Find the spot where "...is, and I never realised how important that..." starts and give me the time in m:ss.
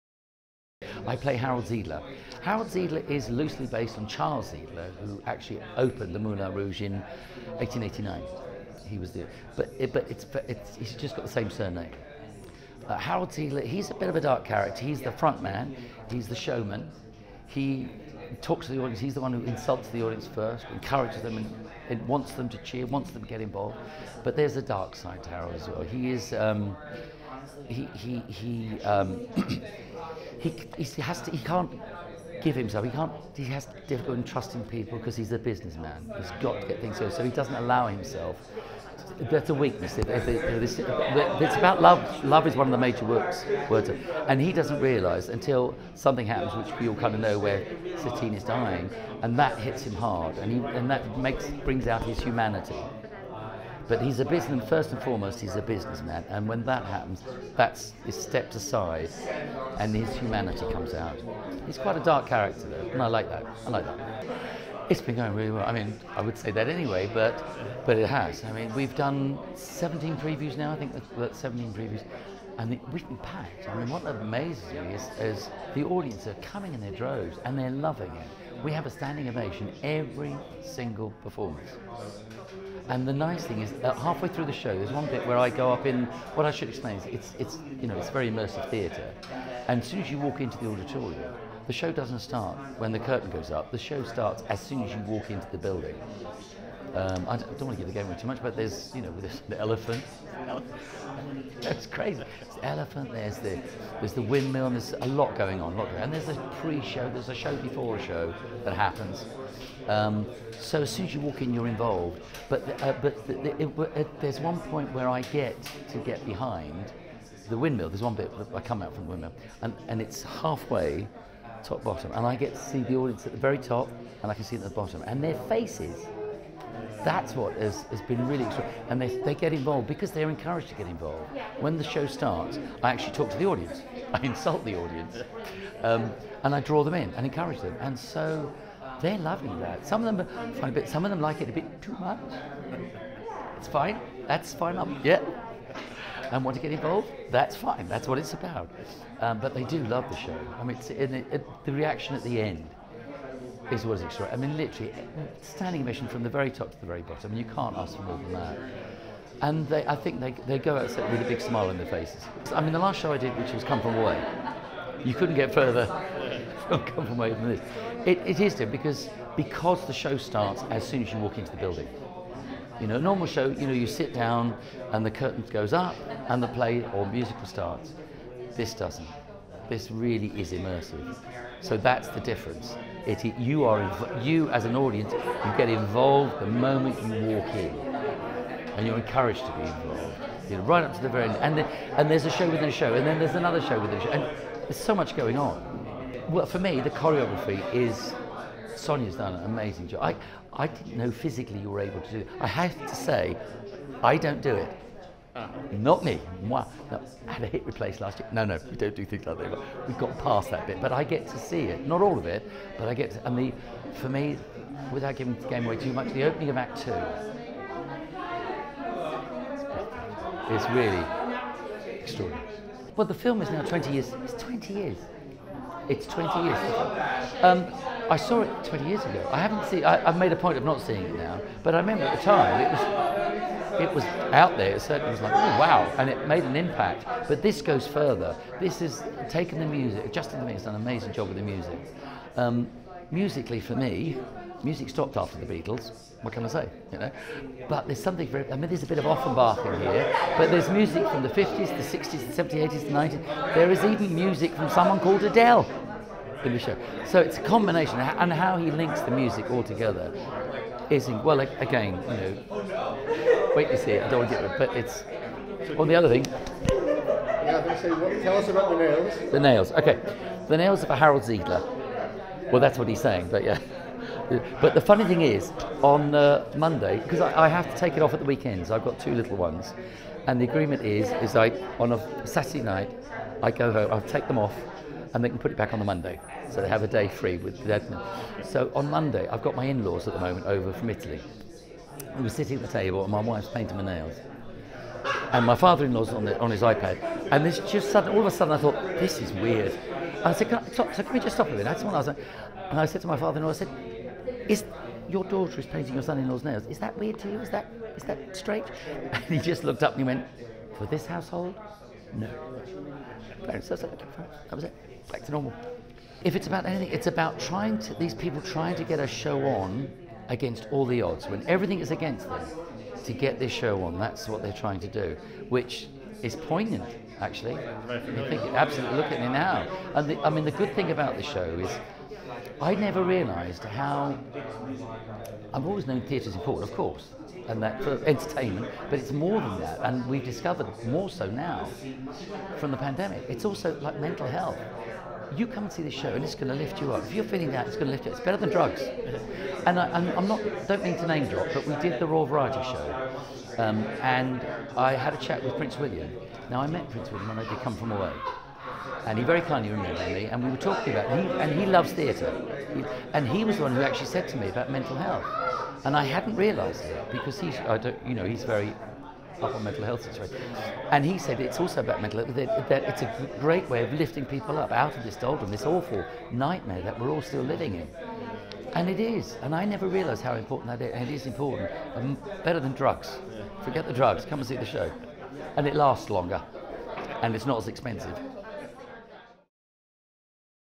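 6:19.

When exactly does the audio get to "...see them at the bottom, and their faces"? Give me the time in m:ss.
2:04.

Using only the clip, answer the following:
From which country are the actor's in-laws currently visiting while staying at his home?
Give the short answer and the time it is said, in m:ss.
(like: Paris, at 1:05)
Italy, at 4:50.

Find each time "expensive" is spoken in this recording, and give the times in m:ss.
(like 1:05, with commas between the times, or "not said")
6:27.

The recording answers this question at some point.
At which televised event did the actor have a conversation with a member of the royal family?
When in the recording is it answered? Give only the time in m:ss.
5:52.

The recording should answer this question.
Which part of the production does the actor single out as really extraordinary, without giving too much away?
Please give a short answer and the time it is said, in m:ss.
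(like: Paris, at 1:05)
opening of Act Two, at 3:36.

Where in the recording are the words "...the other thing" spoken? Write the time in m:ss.
4:25.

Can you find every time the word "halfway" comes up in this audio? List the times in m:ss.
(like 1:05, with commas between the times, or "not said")
1:23, 2:00.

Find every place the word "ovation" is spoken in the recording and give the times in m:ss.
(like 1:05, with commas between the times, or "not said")
1:19, 2:35.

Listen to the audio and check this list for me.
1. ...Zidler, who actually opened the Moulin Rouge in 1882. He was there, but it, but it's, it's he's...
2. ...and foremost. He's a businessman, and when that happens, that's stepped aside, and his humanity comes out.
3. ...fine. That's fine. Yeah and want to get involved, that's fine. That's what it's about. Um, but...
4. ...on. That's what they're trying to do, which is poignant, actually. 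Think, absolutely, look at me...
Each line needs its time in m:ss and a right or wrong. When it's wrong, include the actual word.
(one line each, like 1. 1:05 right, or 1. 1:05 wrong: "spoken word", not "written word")
1. 0:04 wrong: "1889", not "1882"
2. 0:54 right
3. 2:23 right
4. 5:23 right.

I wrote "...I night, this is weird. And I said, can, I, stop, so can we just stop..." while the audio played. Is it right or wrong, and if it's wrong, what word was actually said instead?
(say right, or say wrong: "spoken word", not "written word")
wrong: "thought", not "night".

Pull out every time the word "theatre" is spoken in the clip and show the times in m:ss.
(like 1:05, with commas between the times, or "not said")
1:28, 5:36, 6:01.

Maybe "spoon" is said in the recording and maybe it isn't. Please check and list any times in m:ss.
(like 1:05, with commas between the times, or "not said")
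not said.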